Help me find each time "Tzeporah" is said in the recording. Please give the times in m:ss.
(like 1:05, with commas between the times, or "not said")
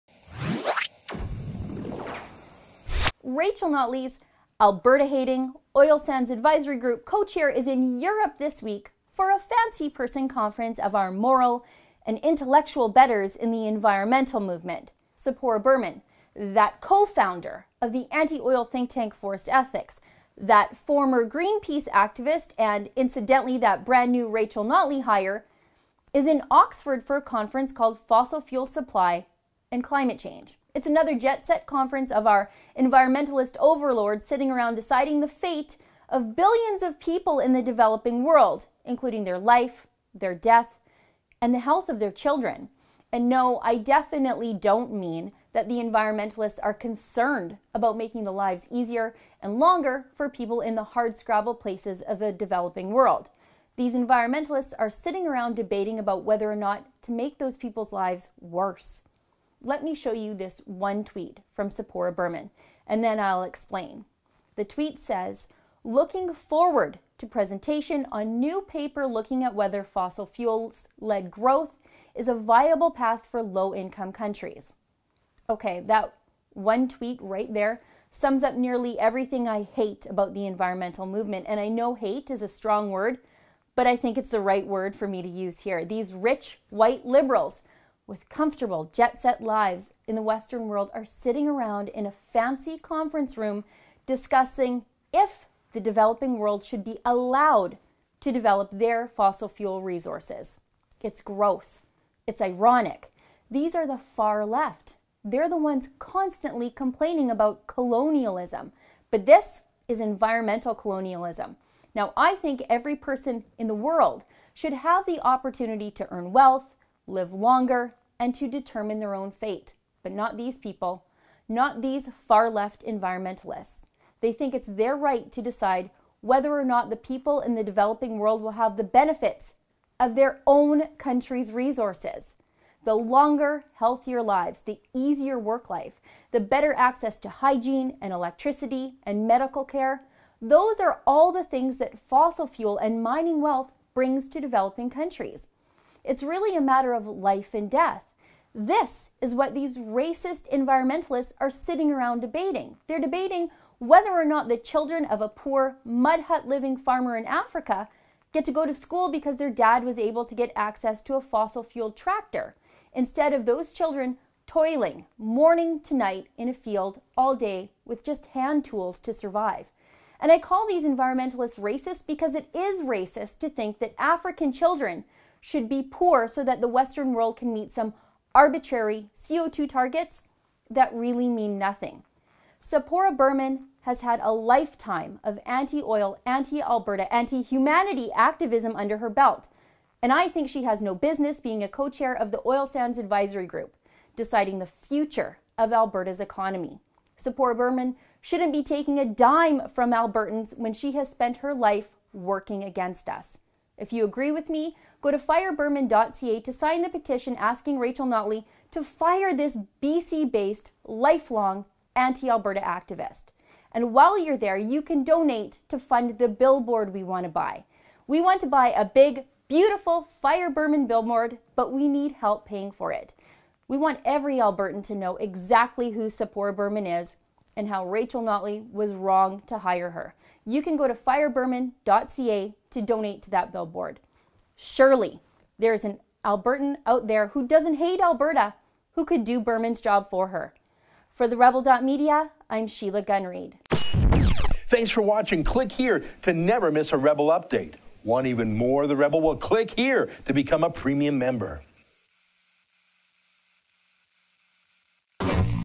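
0:15, 1:01, 3:02, 3:17, 3:46.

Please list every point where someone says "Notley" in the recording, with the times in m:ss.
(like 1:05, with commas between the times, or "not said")
0:03, 0:24, 3:28, 3:48.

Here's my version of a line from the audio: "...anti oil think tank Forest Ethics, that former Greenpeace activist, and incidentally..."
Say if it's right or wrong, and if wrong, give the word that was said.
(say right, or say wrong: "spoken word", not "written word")
right.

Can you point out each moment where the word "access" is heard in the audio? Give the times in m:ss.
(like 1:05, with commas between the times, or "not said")
2:16, 2:40.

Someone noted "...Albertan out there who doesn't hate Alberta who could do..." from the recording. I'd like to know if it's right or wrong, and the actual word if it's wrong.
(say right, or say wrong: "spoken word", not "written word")
right.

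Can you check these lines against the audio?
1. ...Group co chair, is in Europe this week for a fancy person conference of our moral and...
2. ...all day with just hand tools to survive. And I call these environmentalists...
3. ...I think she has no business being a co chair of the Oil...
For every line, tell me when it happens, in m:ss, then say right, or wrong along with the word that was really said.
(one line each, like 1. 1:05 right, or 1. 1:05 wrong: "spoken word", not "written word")
1. 0:06 right
2. 2:47 right
3. 3:10 right.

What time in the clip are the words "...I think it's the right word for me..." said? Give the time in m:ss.
1:23.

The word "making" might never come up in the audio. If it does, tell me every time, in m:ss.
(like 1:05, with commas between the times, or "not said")
0:47.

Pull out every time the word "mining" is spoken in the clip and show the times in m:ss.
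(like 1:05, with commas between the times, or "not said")
2:23.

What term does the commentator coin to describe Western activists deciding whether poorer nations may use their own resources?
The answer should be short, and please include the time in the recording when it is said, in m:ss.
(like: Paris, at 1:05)
environmental colonialism, at 1:50.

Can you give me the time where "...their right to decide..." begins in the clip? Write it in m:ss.
2:04.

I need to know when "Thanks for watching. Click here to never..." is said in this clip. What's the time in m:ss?
4:03.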